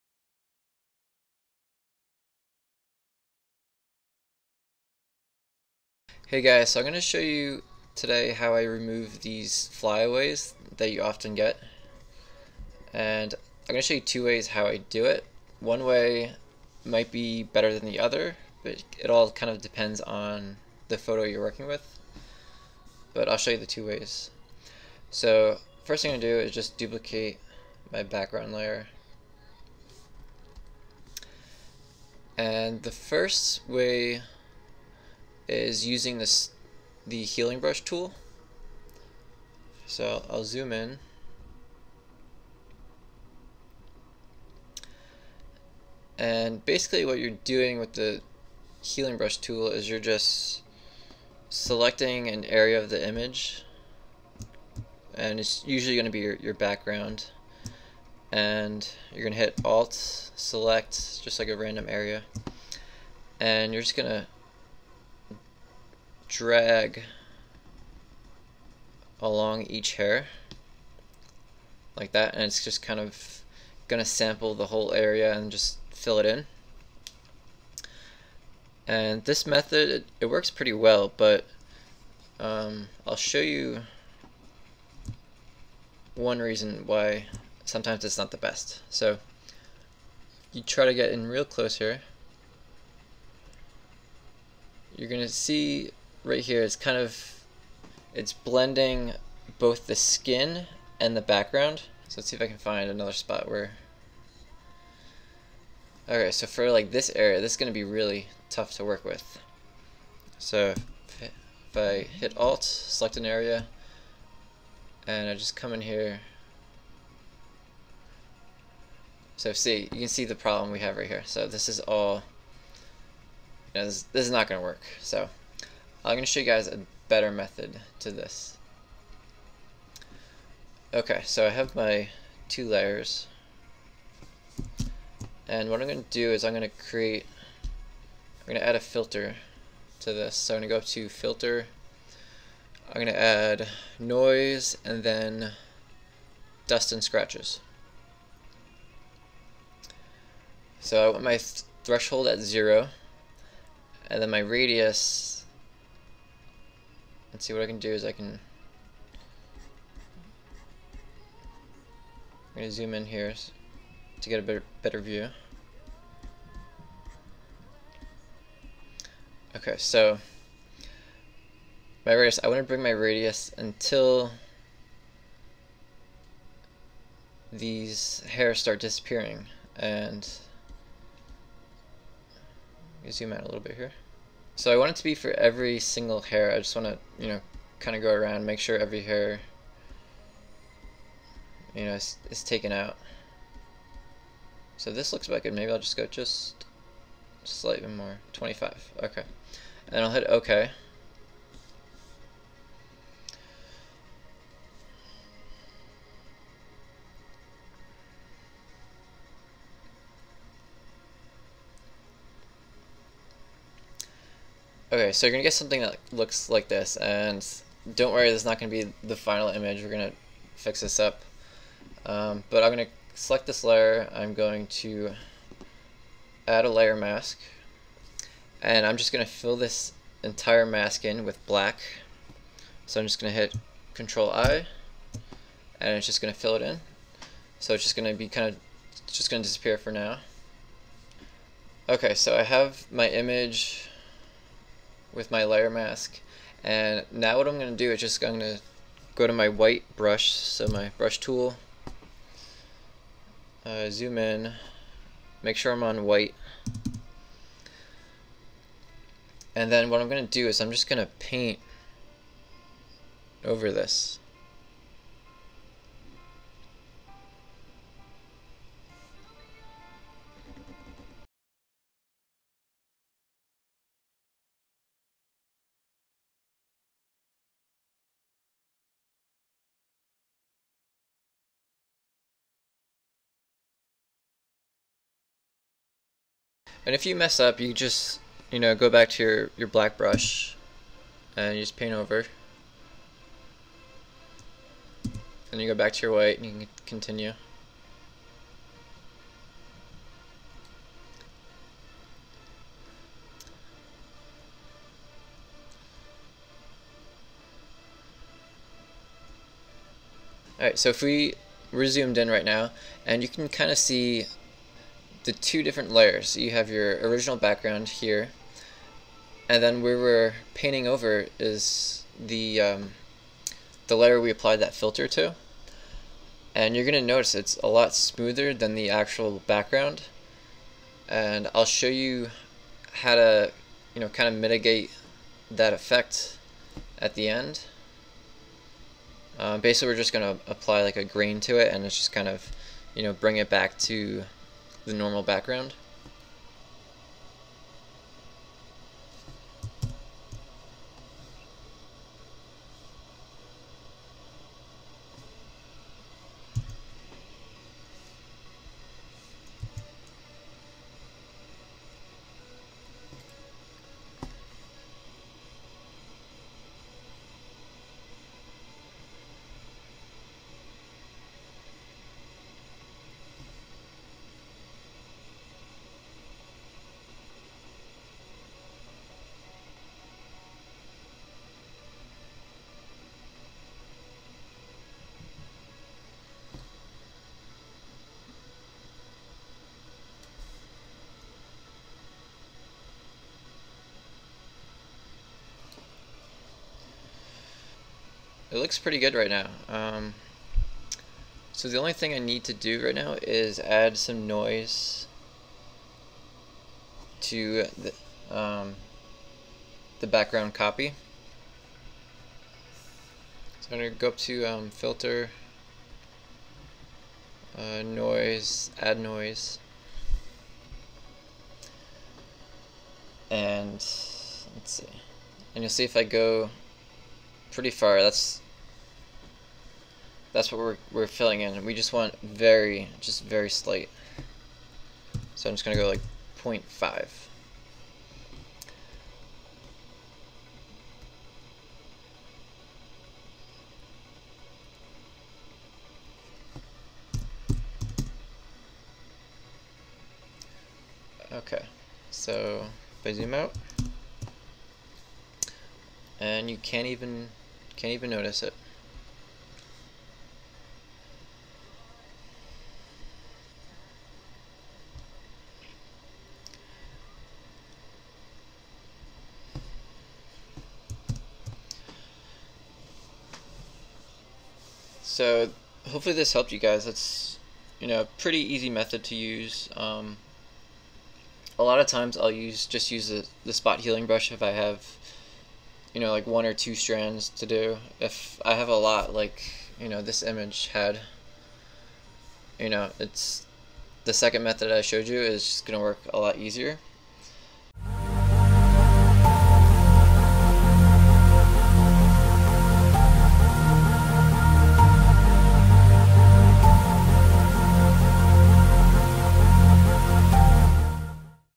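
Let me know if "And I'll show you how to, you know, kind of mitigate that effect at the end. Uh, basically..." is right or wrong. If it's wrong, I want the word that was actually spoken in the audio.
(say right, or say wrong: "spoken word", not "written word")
right.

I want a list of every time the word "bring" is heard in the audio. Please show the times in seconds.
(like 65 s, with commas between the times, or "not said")
172 s, 343 s.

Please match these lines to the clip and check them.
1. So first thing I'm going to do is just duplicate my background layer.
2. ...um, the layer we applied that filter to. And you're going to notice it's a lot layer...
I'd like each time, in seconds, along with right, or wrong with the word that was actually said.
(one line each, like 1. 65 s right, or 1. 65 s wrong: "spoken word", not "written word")
1. 25 s right
2. 322 s wrong: "smoother", not "layer".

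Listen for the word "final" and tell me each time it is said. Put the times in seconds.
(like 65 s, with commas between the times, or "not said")
219 s.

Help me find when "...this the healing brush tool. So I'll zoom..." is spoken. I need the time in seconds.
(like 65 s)
36 s.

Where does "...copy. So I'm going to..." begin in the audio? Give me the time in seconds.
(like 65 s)
410 s.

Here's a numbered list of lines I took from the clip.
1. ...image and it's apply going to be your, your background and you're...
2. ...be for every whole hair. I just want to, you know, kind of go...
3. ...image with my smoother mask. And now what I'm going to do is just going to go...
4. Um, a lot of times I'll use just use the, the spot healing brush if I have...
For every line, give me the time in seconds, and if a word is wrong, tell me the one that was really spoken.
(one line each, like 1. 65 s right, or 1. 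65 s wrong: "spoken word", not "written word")
1. 53 s wrong: "usually", not "apply"
2. 185 s wrong: "single", not "whole"
3. 243 s wrong: "layer", not "smoother"
4. 479 s right.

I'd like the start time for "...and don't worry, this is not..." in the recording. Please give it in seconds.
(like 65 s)
216 s.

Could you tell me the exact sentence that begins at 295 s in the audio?
Then you go back to your white and you can continue.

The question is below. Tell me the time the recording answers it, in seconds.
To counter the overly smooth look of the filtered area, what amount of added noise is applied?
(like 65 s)
436 s.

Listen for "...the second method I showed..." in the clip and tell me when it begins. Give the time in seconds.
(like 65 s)
494 s.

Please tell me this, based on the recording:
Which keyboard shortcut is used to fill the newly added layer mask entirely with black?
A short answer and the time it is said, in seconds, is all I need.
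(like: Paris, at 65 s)
Control-I, at 233 s.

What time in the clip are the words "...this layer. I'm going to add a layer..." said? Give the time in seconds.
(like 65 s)
223 s.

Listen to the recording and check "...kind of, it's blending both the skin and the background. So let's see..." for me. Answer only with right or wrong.
right.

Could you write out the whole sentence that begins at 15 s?
One way might be better than the other, but it all kind of depends on the photo you're working with.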